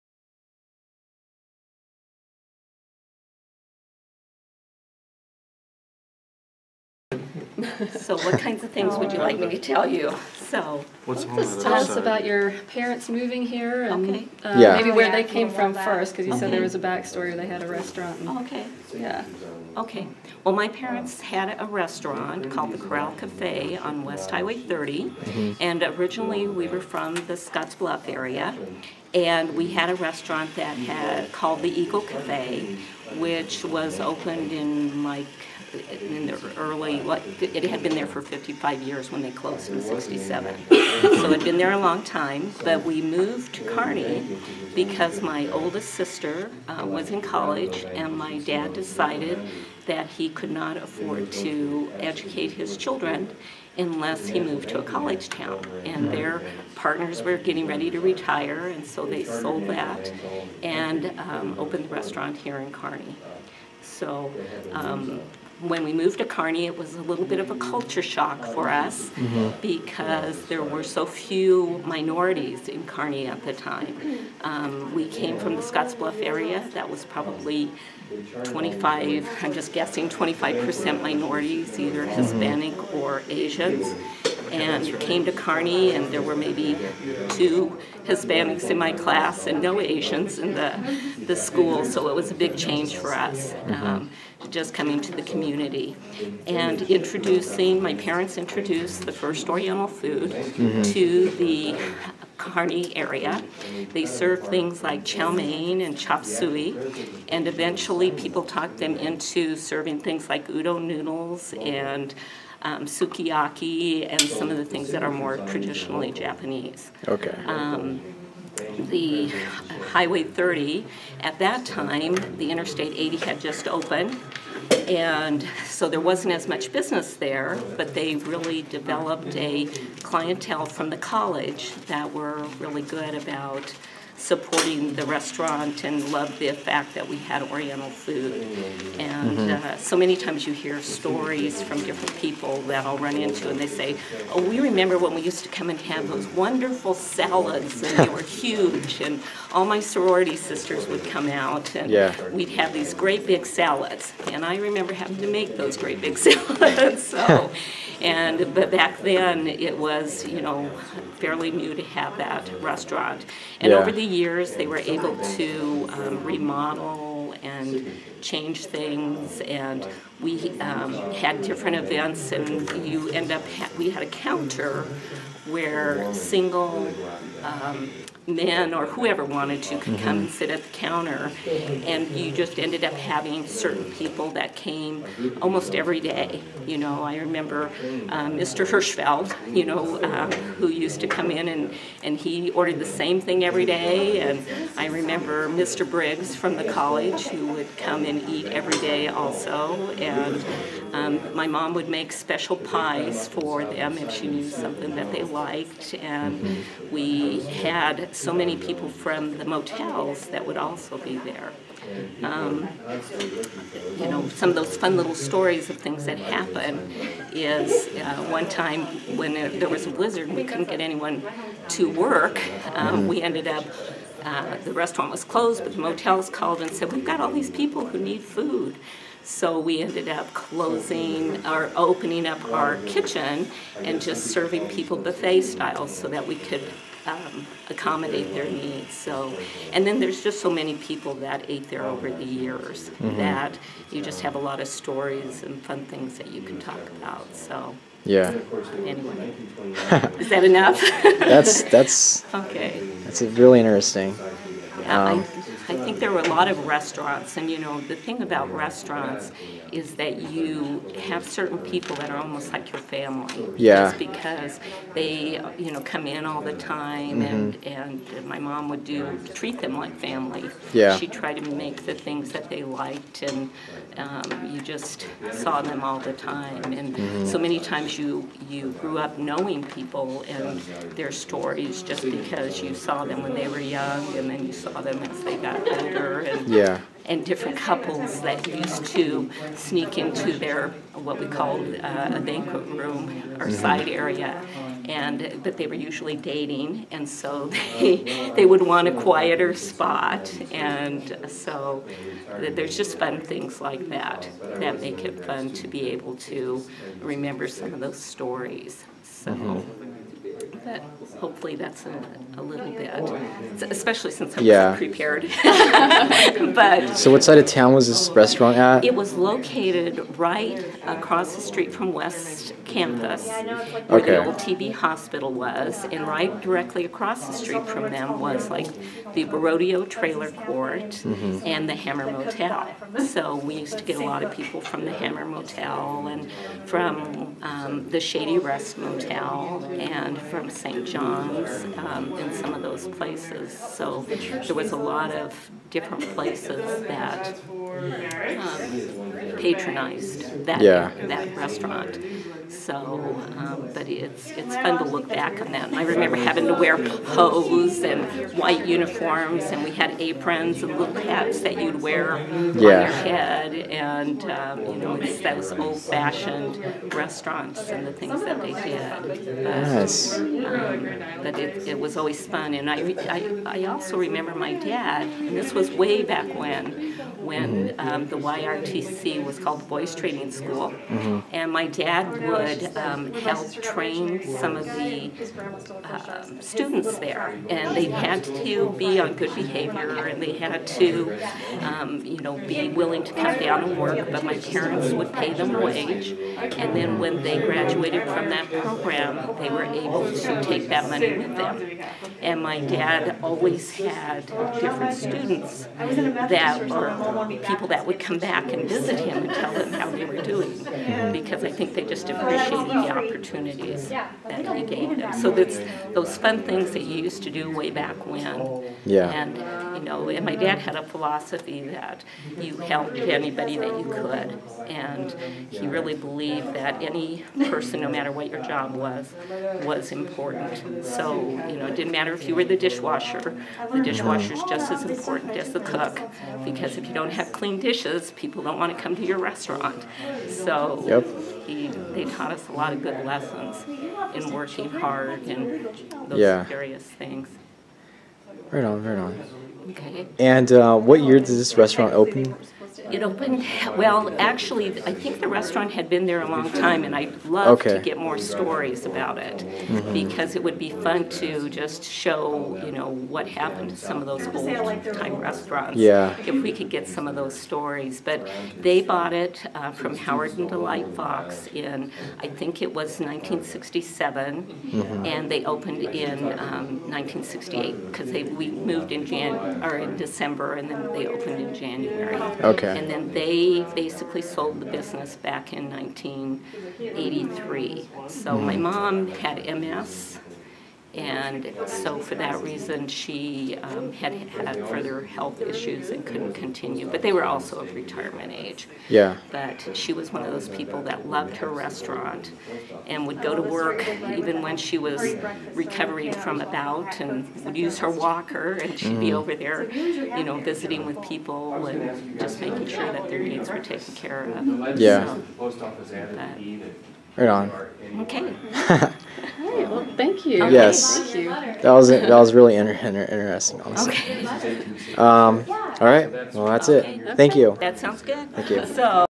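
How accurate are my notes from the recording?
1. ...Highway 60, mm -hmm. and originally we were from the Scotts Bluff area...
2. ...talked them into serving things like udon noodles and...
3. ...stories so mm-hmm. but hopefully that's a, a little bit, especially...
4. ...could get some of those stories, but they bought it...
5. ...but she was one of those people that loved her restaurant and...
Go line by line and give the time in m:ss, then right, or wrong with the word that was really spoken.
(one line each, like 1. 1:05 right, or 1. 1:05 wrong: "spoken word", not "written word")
1. 0:24 wrong: "30", not "60"
2. 1:48 right
3. 5:08 right
4. 7:46 right
5. 8:19 right.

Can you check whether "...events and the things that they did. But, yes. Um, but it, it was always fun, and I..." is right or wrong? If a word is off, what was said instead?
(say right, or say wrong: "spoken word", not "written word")
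wrong: "restaurants", not "events".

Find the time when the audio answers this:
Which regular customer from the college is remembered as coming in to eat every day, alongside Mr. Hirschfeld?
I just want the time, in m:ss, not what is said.
3:15.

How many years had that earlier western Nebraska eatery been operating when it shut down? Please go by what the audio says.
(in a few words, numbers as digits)
55.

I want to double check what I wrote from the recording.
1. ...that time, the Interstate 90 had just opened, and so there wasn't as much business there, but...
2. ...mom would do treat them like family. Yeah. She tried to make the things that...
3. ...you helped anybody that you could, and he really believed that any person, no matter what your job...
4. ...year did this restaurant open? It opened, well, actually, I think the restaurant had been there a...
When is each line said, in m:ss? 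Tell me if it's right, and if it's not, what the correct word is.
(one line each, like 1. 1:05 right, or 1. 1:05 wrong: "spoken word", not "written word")
1. 2:01 wrong: "80", not "90"
2. 4:28 right
3. 7:02 right
4. 7:31 right.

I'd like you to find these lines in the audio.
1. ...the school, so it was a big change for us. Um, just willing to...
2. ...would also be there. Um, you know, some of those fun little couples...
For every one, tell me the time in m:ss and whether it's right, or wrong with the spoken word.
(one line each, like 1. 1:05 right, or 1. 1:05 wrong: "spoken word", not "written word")
1. 1:31 wrong: "coming", not "willing"
2. 3:30 wrong: "stories", not "couples".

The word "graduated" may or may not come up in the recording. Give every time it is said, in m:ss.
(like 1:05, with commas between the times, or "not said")
6:37.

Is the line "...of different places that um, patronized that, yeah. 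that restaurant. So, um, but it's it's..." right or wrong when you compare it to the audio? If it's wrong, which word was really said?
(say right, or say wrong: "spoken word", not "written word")
right.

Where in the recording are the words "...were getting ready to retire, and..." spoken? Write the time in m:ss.
0:57.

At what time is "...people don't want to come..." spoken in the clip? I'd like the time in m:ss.
7:18.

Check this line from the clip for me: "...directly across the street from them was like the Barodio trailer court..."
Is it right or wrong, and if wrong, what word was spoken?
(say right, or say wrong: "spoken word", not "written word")
right.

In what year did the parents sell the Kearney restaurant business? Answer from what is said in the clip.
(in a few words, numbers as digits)
1983.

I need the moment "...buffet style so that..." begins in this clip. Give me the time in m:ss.
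3:54.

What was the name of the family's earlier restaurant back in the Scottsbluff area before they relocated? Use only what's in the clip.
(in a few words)
Eagle Cafe.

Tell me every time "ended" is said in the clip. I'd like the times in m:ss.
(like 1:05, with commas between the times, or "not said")
3:02, 3:43, 3:49.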